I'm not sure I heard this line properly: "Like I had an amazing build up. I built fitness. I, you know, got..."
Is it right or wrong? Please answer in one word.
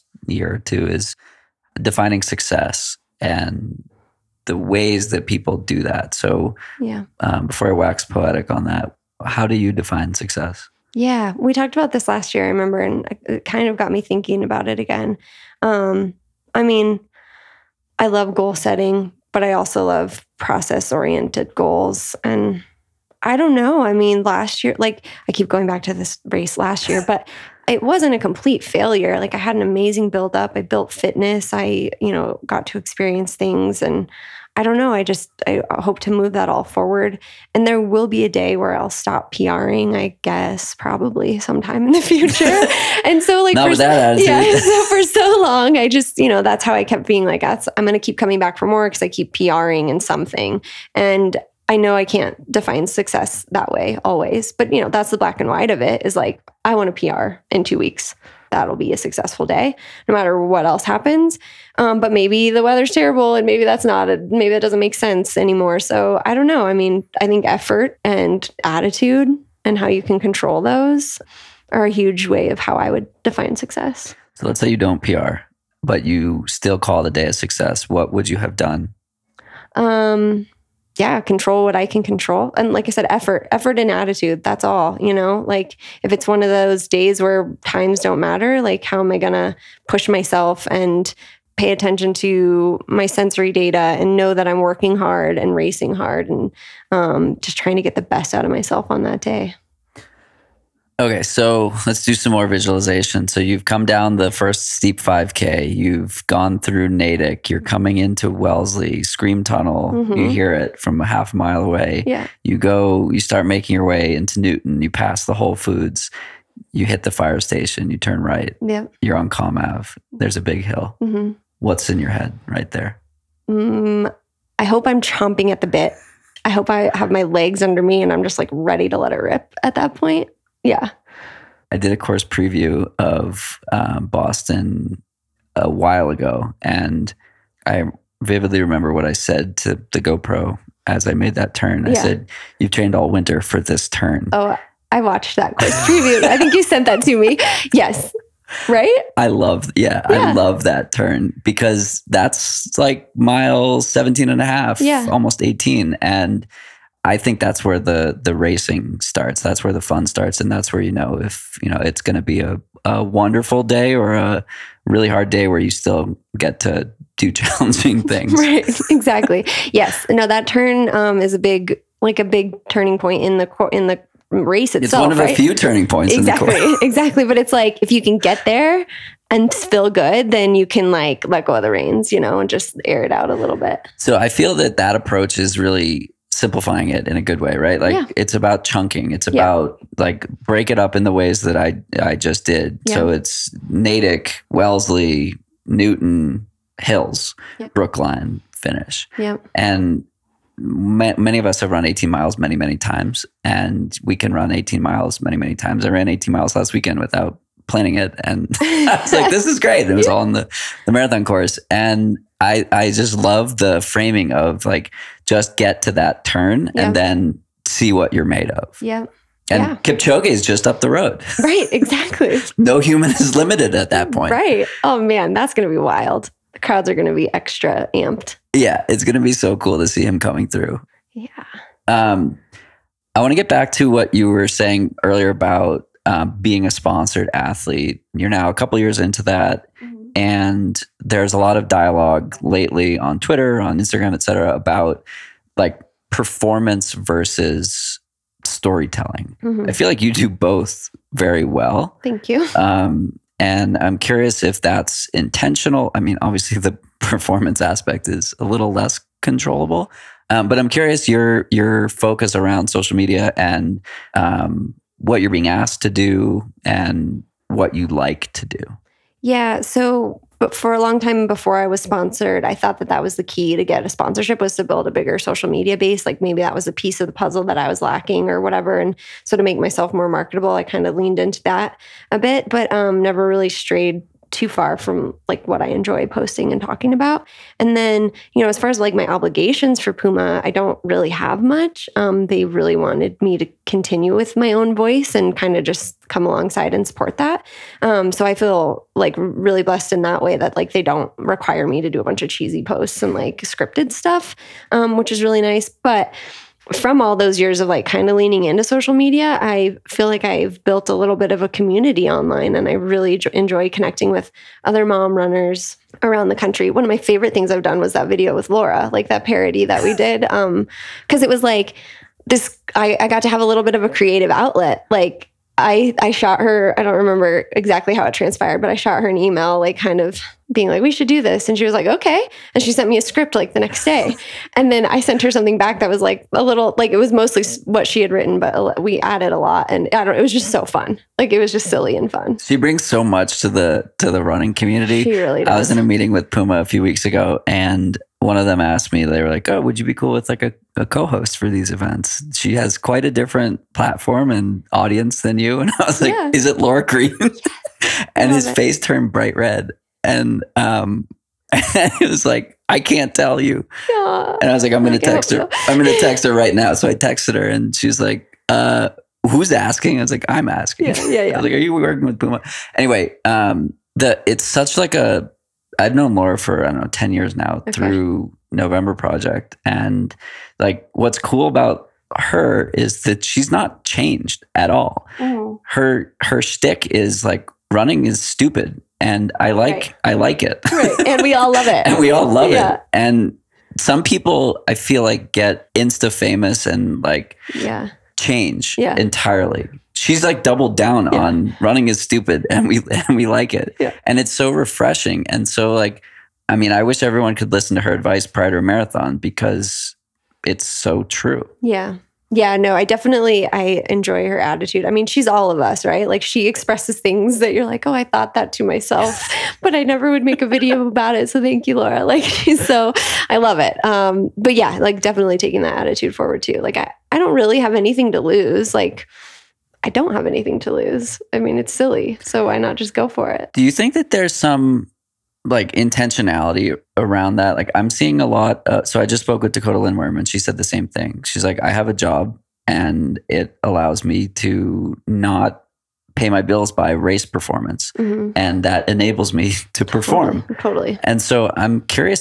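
right.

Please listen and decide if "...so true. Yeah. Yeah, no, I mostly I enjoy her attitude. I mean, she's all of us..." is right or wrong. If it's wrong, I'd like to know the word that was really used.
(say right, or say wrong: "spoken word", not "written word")
wrong: "definitely", not "mostly".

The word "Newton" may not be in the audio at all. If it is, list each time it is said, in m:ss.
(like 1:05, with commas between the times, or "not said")
1:54, 3:15.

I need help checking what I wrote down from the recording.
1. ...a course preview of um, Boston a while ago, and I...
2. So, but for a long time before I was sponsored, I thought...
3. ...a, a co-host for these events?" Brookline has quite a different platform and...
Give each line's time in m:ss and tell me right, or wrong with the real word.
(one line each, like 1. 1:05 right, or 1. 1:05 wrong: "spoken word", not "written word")
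1. 2:11 right
2. 4:29 right
3. 5:50 wrong: "She", not "Brookline".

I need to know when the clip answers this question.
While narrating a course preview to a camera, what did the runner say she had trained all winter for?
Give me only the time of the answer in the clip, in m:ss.
2:22.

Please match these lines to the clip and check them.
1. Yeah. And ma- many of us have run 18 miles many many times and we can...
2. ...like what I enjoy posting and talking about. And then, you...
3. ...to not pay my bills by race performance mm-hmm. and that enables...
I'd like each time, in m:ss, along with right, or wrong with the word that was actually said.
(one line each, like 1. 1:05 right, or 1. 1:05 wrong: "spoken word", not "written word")
1. 3:19 right
2. 4:45 right
3. 7:24 right.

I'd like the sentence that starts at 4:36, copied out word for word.
Like maybe that was a piece of the puzzle that I was lacking or whatever.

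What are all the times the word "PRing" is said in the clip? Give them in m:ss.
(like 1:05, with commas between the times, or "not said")
0:39, 0:49.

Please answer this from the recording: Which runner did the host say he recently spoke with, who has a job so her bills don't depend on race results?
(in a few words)
Dakota Lindwurm.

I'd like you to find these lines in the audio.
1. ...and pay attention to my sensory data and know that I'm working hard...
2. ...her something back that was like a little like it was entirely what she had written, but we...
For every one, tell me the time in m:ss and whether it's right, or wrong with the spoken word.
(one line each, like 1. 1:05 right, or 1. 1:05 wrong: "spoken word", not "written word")
1. 1:30 right
2. 5:35 wrong: "mostly", not "entirely".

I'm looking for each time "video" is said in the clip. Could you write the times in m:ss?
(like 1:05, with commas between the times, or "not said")
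5:18, 7:00.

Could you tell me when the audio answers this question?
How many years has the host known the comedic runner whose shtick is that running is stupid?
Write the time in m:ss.
6:16.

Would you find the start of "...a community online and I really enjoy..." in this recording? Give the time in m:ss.
5:11.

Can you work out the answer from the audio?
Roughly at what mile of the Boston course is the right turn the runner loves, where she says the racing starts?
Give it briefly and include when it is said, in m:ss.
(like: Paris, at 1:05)
17.5, at 2:33.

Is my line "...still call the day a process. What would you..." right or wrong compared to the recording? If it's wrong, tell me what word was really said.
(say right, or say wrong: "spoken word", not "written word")
wrong: "success", not "process".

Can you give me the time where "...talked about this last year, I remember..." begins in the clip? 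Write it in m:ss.
0:11.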